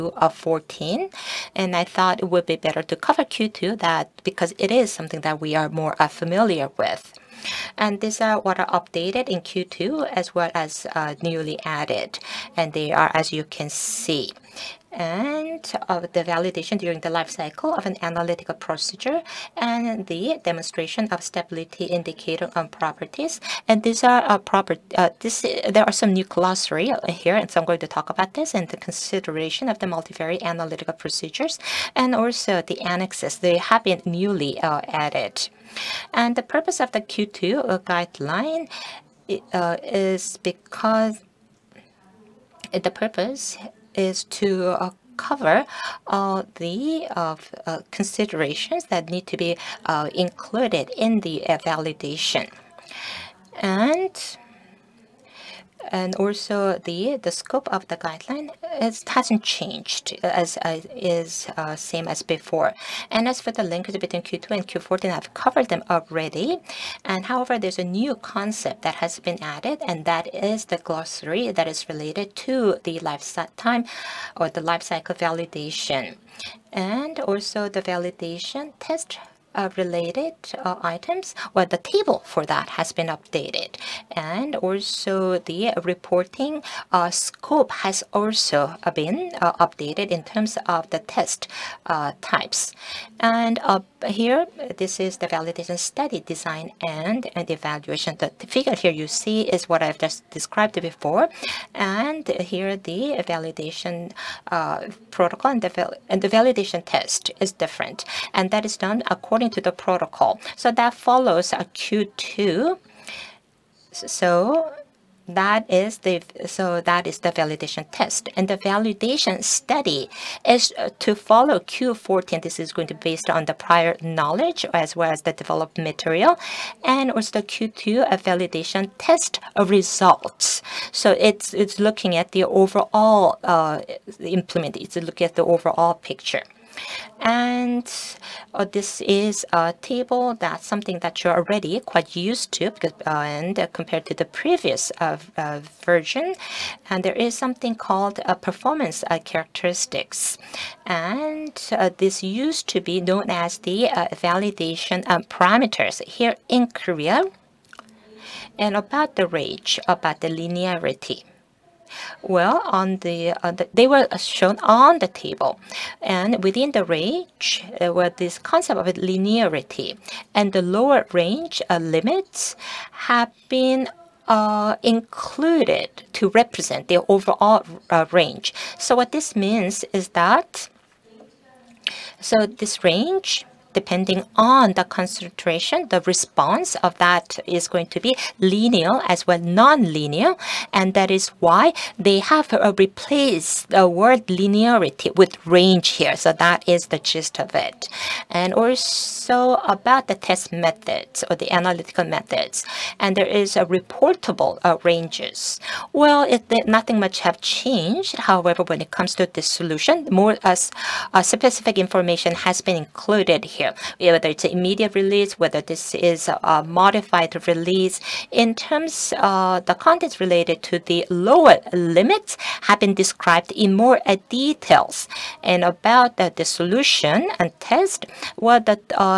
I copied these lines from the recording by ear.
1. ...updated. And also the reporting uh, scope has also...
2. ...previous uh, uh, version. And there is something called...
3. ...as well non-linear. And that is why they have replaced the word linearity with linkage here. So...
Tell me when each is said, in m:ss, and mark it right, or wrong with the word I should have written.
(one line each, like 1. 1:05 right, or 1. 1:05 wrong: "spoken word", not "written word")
1. 1:23 right
2. 2:24 right
3. 3:09 wrong: "range", not "linkage".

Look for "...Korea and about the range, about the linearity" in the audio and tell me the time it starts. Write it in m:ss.
2:36.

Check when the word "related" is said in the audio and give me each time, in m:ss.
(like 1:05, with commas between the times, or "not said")
1:11, 1:19, 3:40.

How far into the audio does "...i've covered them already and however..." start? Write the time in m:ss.
1:05.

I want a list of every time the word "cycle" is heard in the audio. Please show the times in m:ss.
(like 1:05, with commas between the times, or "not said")
0:17, 1:14.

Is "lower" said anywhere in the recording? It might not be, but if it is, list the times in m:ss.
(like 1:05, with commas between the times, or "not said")
2:50, 3:41.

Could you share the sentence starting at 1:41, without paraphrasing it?
And here the validation protocol and the, and the validation test is different.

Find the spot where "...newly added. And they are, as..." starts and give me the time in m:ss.
0:11.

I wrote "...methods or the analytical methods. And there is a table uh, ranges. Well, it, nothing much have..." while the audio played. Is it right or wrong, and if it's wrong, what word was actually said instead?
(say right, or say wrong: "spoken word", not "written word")
wrong: "reportable", not "table".